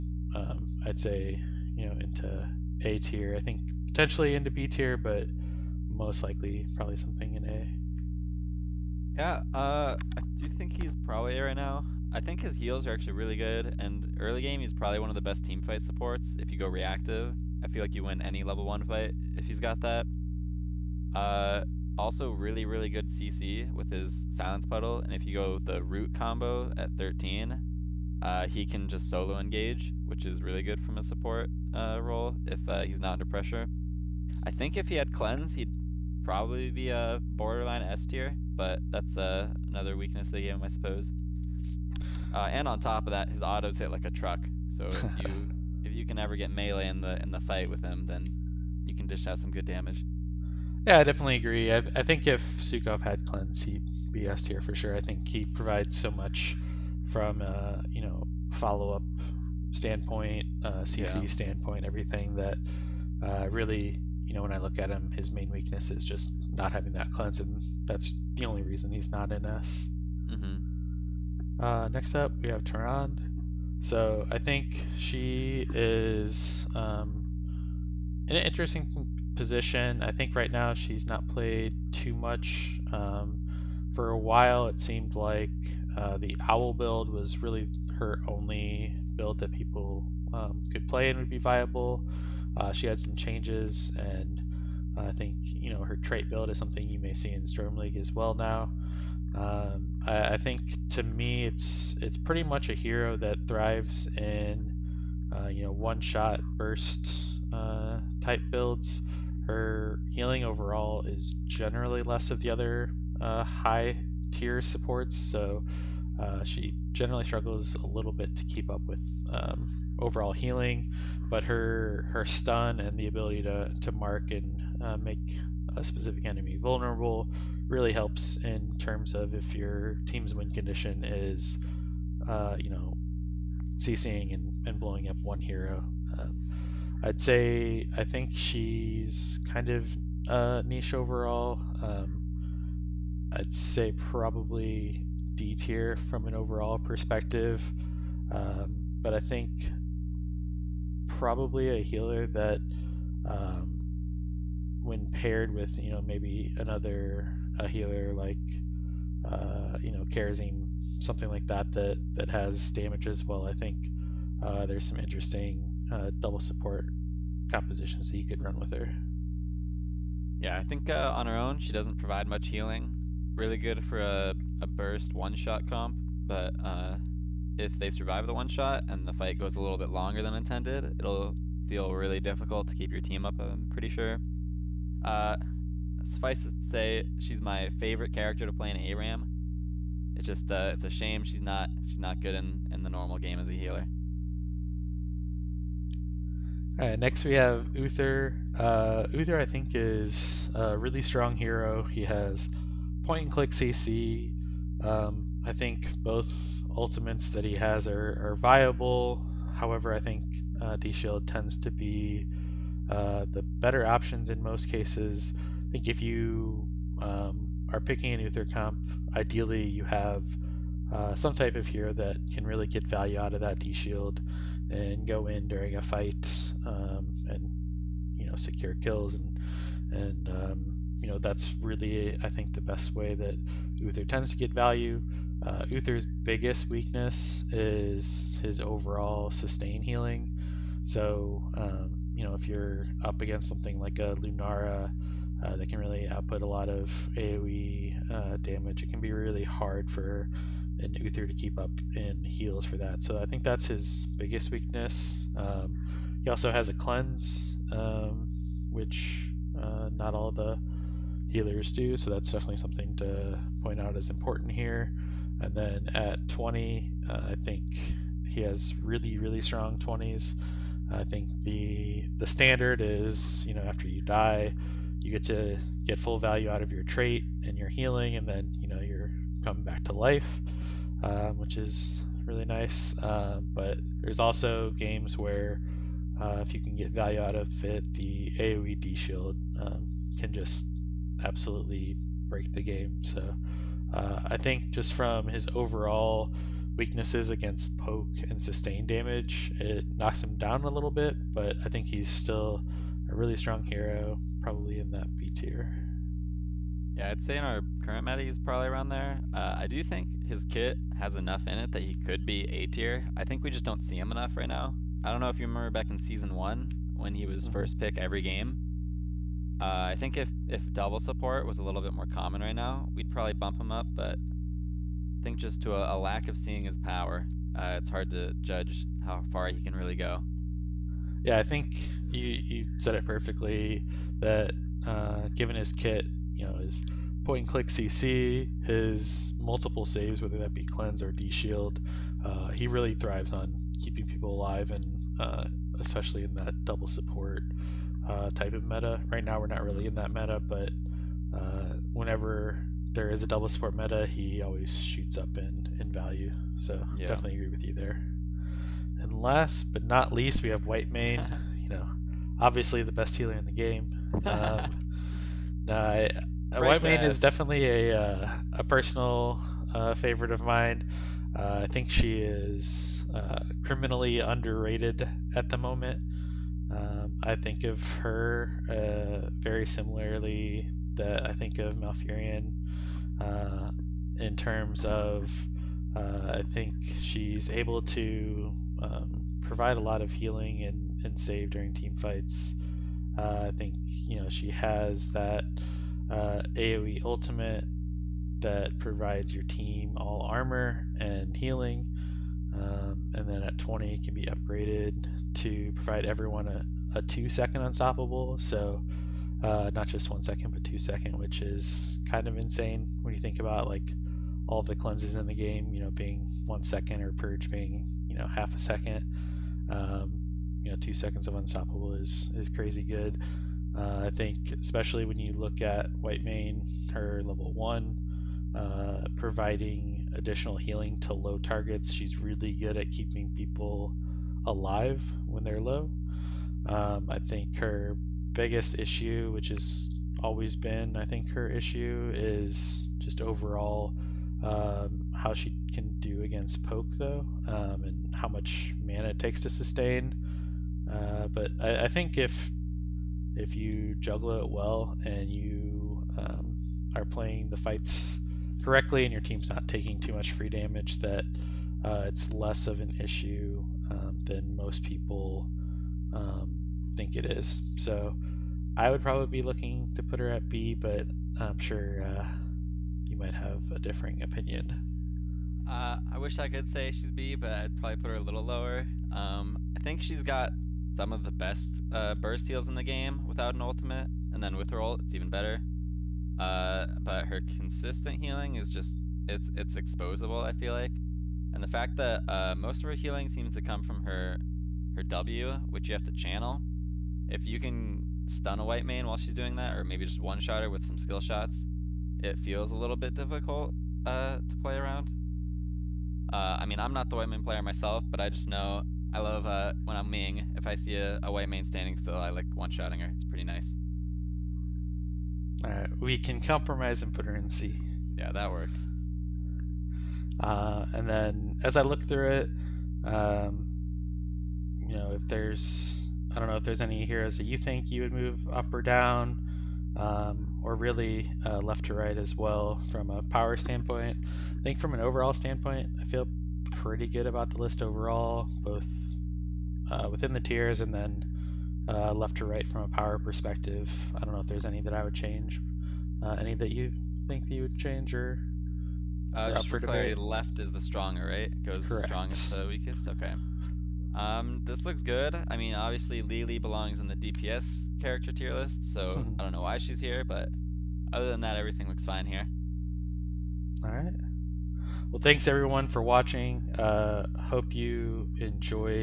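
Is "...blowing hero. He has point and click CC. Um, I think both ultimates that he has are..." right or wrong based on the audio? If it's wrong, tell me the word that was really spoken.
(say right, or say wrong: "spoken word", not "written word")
wrong: "strong", not "blowing".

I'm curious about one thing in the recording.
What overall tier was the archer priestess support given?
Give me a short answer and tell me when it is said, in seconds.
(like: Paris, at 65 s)
D tier, at 145 s.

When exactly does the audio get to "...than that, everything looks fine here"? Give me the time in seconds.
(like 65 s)
561 s.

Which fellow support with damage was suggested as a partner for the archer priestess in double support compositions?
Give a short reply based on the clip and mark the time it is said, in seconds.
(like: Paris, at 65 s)
Kharazim, at 160 s.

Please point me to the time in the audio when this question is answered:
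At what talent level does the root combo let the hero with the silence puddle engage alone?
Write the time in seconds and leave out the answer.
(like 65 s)
26 s.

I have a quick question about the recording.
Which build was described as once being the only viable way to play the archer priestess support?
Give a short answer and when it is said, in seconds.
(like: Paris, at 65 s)
owl build, at 86 s.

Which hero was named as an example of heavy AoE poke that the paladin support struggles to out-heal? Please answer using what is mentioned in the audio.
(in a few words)
Lunara.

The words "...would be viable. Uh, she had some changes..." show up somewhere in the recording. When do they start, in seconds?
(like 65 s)
91 s.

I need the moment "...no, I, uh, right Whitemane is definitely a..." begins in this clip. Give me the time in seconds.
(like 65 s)
365 s.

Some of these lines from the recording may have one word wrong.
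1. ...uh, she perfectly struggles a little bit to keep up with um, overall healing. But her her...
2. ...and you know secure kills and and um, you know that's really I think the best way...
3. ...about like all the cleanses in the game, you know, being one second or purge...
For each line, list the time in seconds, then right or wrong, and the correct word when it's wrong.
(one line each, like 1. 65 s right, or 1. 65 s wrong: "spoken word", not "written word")
1. 116 s wrong: "generally", not "perfectly"
2. 227 s right
3. 413 s right.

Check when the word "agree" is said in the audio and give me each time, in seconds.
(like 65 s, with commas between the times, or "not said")
51 s, 357 s.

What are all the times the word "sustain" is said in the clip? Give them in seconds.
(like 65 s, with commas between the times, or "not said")
239 s, 298 s, 449 s.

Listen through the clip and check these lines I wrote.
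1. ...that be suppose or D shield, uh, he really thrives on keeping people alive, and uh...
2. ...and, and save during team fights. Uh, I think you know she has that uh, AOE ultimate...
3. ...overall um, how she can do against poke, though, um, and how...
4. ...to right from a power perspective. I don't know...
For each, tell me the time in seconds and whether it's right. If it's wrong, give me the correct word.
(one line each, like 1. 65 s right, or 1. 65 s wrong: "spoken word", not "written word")
1. 340 s wrong: "cleanse", not "suppose"
2. 390 s right
3. 443 s right
4. 542 s right.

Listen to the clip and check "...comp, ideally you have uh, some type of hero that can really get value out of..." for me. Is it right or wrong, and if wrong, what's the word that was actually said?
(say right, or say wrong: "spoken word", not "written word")
right.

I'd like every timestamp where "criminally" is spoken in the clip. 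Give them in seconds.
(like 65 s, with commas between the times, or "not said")
373 s.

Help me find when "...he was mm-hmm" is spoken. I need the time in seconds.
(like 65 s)
317 s.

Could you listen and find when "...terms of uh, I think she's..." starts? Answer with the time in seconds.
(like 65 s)
384 s.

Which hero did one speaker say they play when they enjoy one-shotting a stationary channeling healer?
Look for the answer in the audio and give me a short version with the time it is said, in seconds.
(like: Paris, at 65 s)
Ming, at 510 s.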